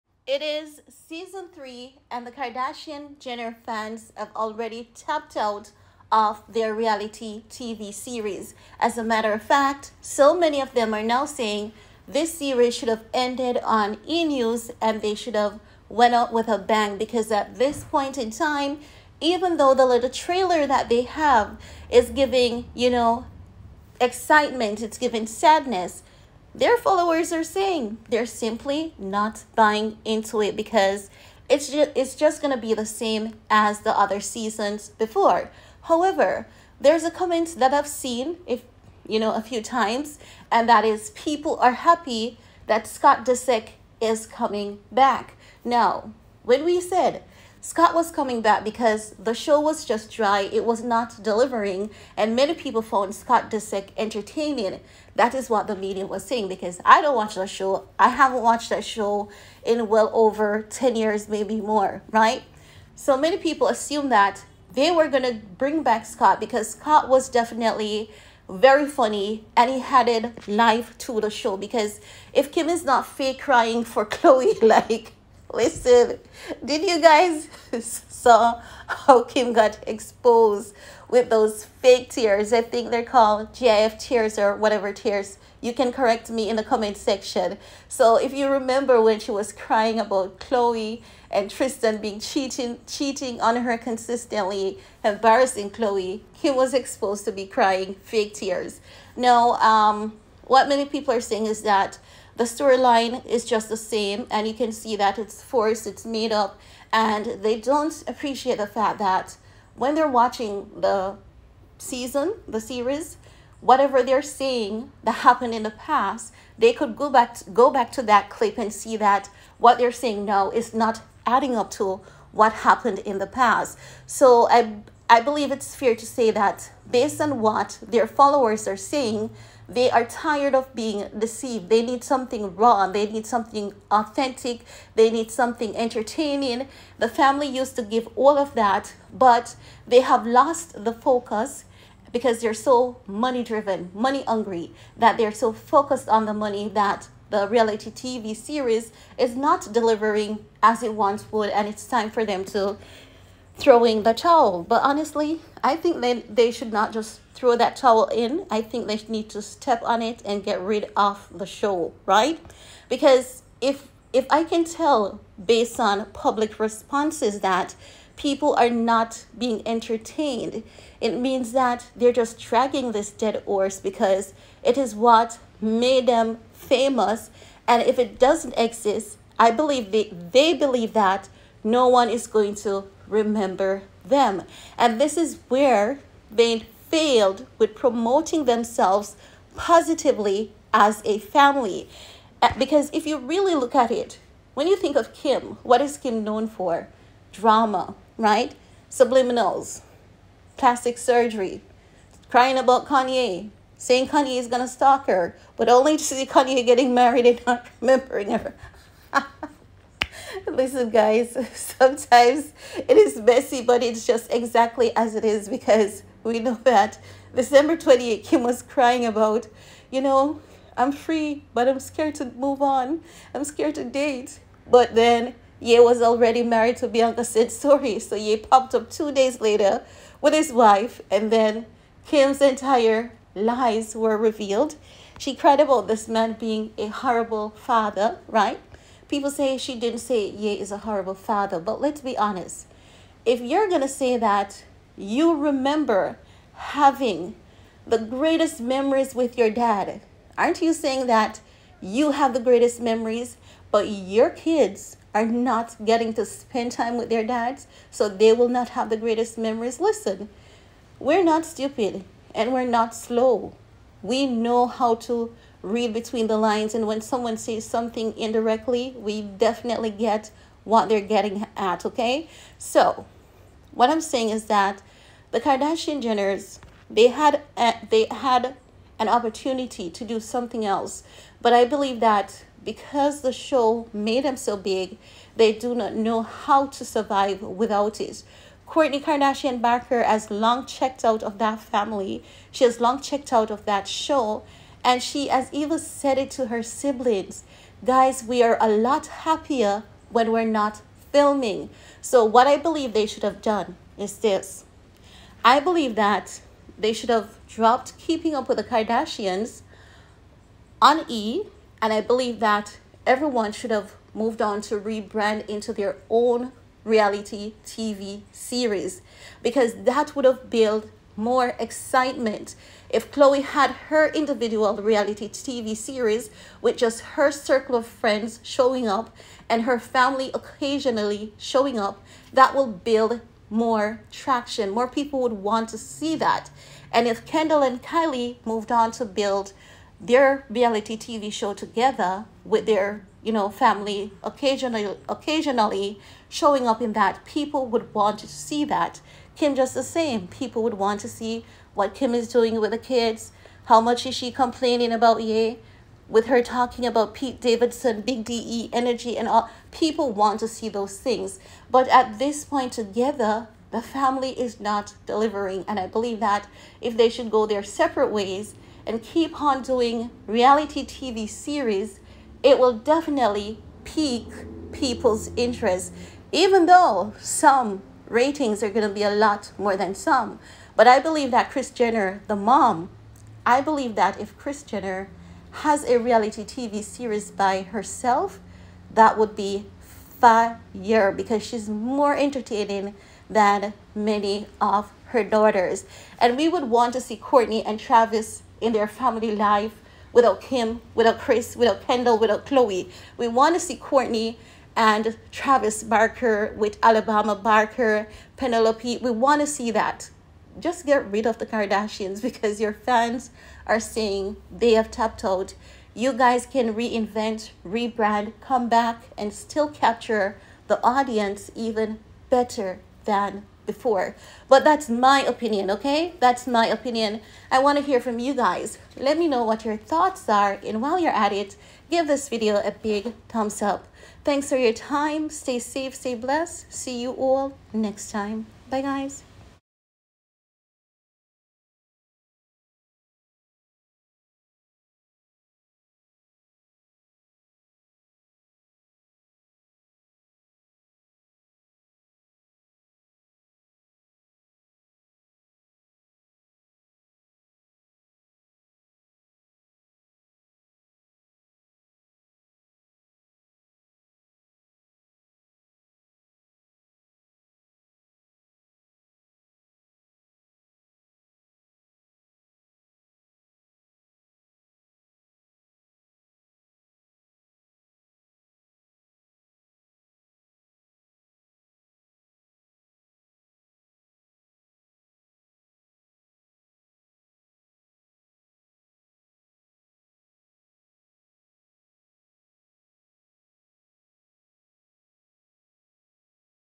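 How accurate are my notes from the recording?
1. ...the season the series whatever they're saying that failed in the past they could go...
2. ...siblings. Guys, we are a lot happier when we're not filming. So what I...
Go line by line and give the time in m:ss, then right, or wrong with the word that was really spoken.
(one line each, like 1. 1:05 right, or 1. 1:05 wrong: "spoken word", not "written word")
1. 1:50 wrong: "happened", not "failed"
2. 4:56 right.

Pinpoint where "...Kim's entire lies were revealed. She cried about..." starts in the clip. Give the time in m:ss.
3:52.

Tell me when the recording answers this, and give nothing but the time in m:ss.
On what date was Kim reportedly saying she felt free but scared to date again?
3:37.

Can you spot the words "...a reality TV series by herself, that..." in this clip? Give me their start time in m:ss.
6:25.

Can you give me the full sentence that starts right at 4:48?
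Kourtney Kardashian Barker has long checked out of that family.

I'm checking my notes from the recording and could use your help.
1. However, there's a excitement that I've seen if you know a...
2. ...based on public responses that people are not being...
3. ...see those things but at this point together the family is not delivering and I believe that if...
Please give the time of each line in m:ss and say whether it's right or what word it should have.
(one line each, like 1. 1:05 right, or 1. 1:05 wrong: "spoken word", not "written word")
1. 0:35 wrong: "comment", not "excitement"
2. 2:45 right
3. 6:00 right.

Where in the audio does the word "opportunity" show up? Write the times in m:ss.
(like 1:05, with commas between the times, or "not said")
4:39.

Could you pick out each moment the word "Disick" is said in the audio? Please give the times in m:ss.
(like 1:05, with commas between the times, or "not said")
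0:43, 0:53.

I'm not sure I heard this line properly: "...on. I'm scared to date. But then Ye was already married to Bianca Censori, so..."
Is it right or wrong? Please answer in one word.
right.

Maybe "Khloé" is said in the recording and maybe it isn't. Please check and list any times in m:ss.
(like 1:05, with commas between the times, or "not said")
1:14, 1:30, 1:35, 5:23, 6:42.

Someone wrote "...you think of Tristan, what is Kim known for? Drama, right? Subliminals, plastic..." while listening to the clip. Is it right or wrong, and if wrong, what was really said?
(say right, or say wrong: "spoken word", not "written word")
wrong: "Kim", not "Tristan".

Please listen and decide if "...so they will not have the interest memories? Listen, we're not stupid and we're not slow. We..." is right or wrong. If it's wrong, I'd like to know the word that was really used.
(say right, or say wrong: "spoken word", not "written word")
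wrong: "greatest", not "interest".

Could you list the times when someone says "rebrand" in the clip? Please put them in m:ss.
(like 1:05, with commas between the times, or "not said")
5:14, 6:57.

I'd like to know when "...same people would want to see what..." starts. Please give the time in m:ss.
5:49.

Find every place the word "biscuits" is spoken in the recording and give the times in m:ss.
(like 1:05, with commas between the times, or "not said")
not said.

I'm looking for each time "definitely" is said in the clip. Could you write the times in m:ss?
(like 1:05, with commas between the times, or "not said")
1:07, 4:29, 6:12.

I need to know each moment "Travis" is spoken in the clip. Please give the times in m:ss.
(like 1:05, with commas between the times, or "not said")
6:37, 6:45.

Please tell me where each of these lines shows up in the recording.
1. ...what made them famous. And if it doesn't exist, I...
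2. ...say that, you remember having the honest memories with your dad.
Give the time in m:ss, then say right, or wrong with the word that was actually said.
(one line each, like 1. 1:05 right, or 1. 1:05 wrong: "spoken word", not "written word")
1. 2:54 right
2. 4:03 wrong: "greatest", not "honest".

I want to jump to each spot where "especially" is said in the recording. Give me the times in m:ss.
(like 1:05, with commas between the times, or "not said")
not said.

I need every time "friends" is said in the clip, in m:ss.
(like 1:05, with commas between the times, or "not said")
5:27.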